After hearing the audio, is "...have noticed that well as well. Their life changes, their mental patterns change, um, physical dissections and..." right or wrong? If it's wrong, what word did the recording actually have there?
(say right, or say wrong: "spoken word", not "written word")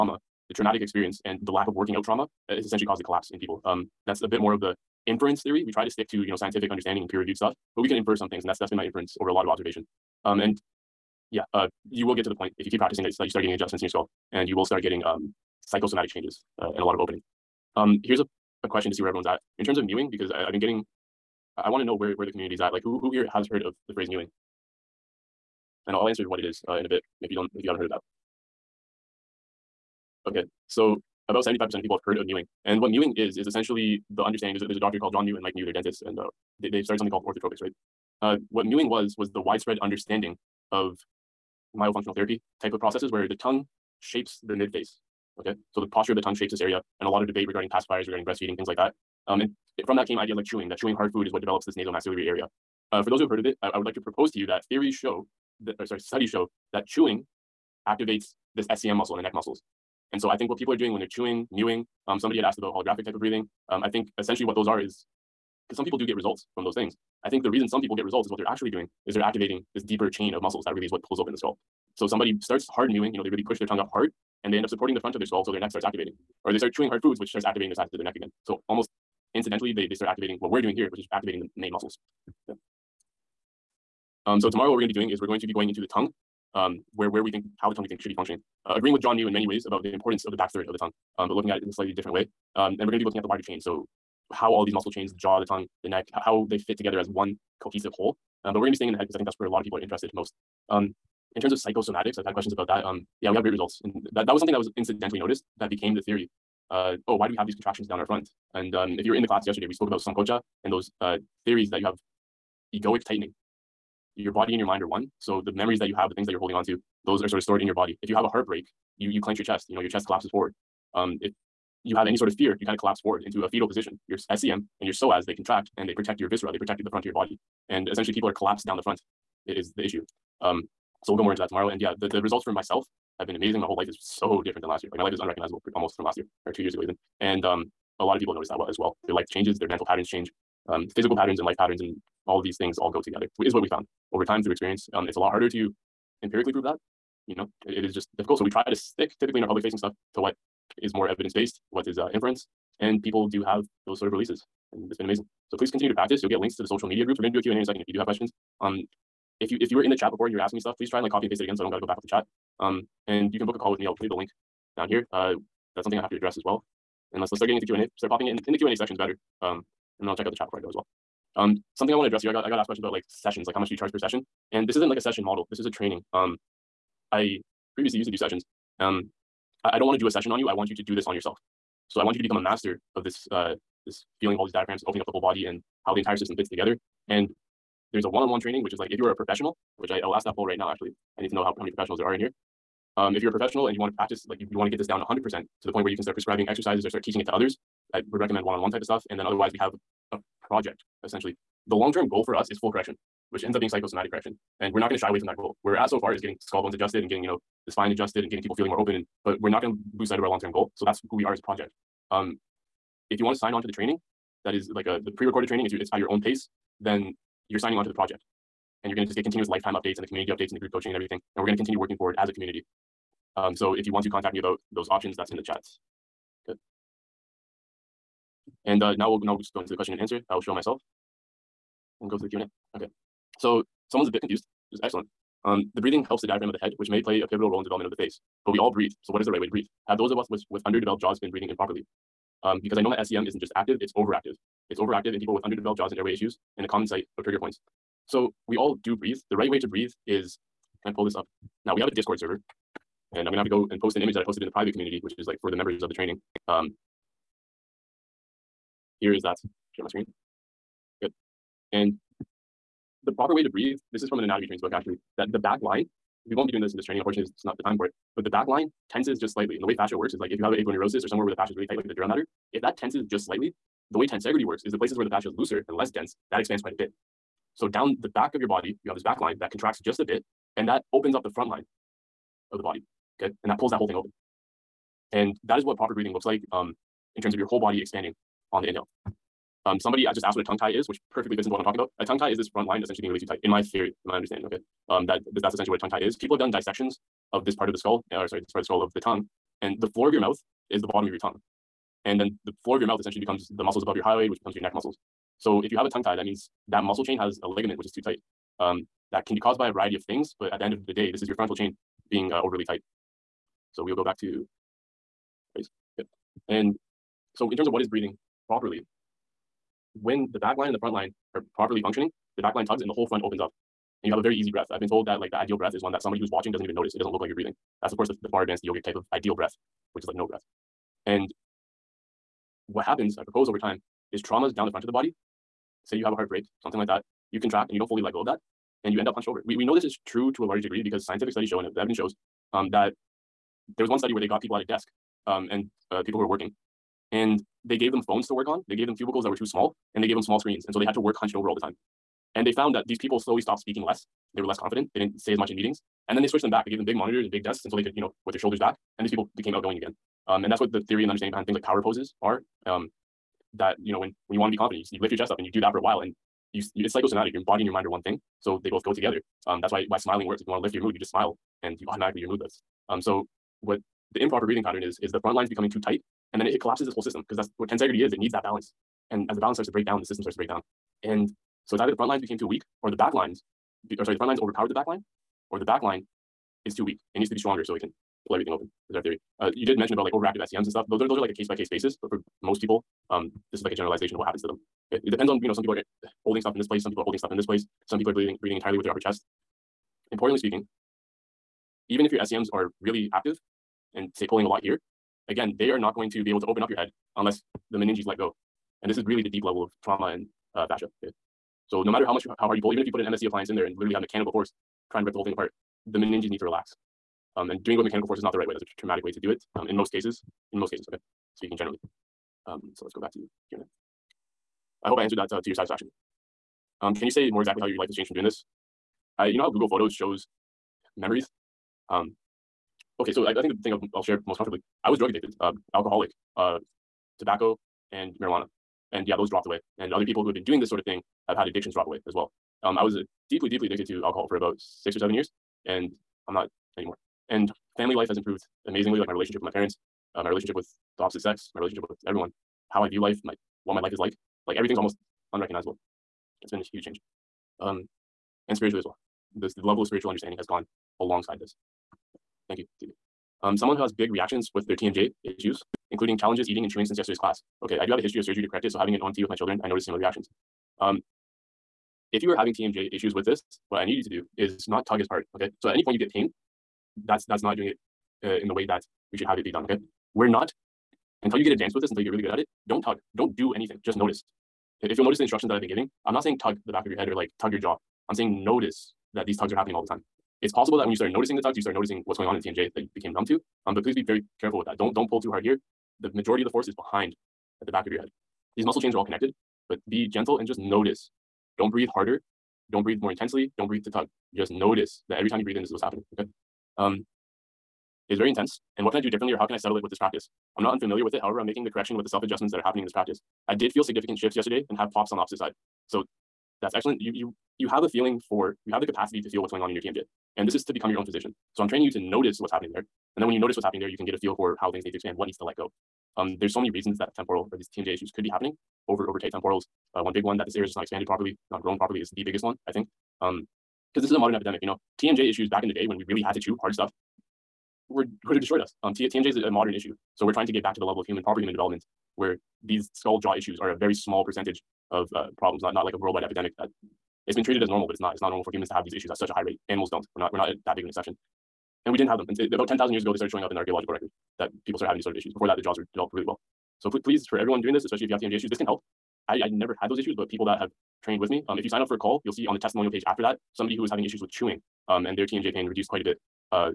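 wrong: "patterns", not "dissections".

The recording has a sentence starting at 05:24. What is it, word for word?
I've been told that like the ideal breath is one that somebody who's watching doesn't even notice.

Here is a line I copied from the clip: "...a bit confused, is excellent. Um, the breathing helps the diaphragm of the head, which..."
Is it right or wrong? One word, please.
right.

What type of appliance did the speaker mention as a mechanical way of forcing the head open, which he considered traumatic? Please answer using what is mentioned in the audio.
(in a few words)
MSE appliance.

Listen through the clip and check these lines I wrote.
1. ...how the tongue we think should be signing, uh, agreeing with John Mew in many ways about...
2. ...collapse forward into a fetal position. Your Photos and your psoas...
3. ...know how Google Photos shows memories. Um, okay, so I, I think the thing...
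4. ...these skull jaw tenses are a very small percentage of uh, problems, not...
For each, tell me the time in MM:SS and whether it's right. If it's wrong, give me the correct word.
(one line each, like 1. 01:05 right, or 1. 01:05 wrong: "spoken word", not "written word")
1. 01:27 wrong: "functioning", not "signing"
2. 02:02 wrong: "SCM", not "Photos"
3. 07:09 right
4. 09:02 wrong: "issues", not "tenses".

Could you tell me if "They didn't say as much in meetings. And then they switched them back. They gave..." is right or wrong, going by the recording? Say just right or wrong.
right.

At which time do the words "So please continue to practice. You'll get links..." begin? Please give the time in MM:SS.
02:35.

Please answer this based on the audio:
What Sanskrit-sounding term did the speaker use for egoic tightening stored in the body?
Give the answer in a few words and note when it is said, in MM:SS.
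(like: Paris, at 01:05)
sankocha, at 01:49.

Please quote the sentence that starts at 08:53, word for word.
Um, because this is a modern epidemic, you know.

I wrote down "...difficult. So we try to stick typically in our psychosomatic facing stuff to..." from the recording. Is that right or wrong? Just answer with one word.
wrong.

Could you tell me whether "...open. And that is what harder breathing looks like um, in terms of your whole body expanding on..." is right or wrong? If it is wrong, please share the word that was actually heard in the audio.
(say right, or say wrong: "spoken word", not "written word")
wrong: "proper", not "harder".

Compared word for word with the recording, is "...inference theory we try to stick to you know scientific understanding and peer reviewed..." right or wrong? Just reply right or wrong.
right.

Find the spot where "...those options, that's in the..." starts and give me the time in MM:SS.
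03:44.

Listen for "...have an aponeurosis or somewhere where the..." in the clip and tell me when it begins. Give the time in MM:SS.
04:30.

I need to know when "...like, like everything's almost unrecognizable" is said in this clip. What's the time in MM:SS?
07:33.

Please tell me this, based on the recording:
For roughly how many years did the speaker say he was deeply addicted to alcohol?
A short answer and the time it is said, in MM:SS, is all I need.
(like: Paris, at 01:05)
6 or 7 years, at 07:24.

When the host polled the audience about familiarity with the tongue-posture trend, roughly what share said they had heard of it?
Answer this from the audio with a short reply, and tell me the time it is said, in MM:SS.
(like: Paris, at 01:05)
75%, at 00:31.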